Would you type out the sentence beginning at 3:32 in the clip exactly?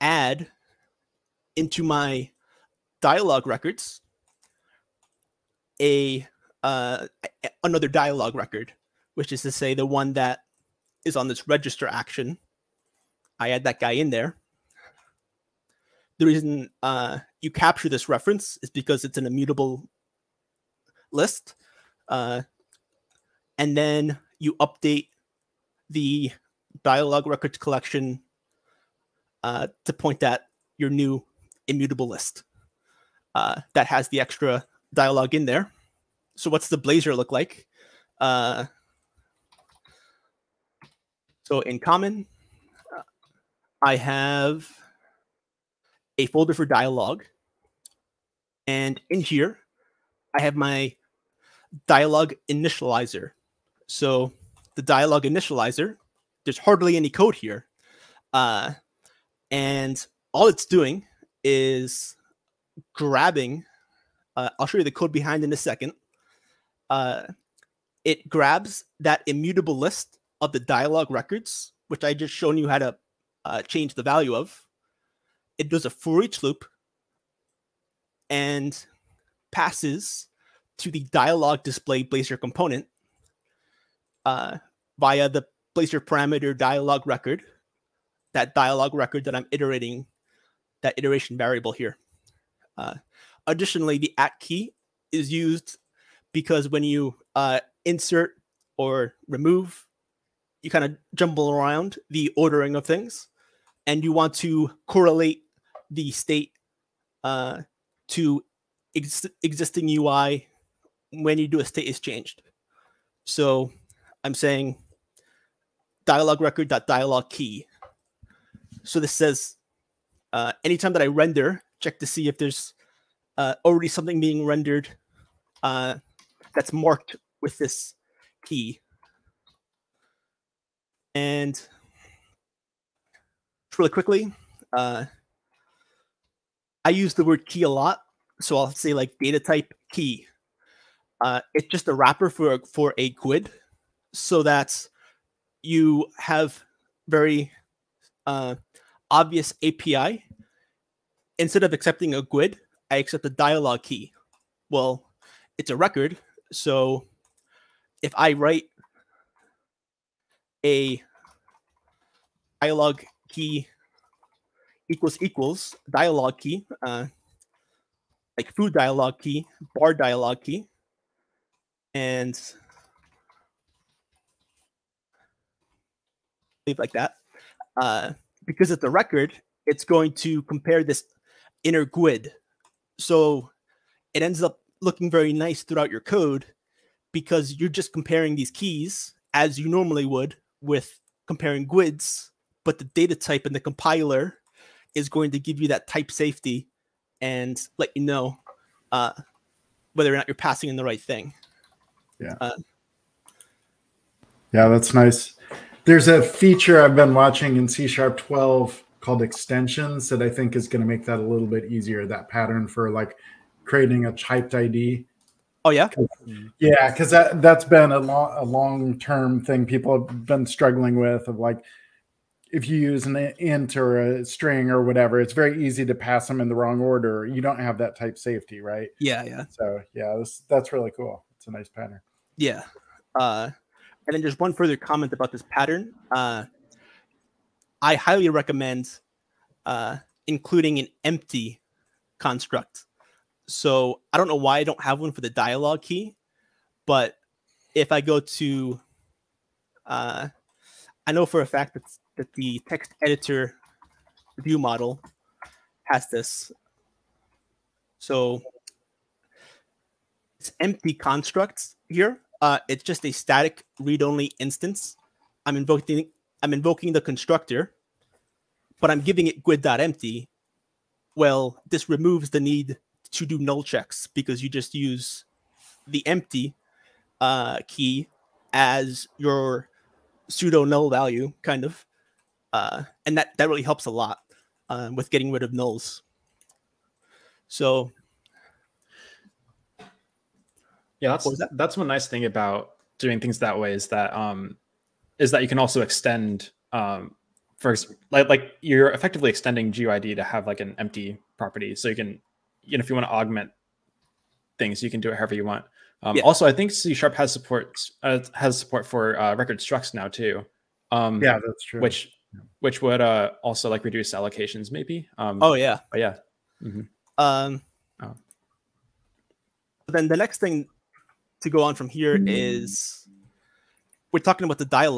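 That pattern for like creating a typed ID.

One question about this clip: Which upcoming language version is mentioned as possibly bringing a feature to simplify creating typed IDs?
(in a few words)
C# 12.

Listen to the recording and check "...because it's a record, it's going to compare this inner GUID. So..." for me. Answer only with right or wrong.
right.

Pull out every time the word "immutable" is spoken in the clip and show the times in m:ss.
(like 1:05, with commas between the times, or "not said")
0:19, 0:31, 1:09.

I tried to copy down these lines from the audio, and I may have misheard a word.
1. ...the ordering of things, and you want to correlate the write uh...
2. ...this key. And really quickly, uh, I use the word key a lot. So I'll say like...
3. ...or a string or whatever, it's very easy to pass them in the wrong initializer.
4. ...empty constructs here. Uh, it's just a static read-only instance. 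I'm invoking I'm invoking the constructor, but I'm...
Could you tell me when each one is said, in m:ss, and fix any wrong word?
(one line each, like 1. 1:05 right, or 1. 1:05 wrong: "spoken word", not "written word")
1. 1:42 wrong: "state", not "write"
2. 2:07 right
3. 3:43 wrong: "order", not "initializer"
4. 4:20 right.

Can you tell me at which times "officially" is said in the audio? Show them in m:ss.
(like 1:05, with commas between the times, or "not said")
not said.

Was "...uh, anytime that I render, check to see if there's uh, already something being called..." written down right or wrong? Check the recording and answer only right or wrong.
wrong.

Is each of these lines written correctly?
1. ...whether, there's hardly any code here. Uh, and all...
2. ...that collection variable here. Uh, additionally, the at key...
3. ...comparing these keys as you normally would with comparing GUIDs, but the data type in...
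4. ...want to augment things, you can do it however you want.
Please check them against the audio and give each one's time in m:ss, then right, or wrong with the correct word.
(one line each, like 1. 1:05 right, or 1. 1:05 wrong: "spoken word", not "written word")
1. 0:55 wrong: "initializer", not "whether"
2. 1:30 wrong: "iteration", not "collection"
3. 3:07 right
4. 5:02 right.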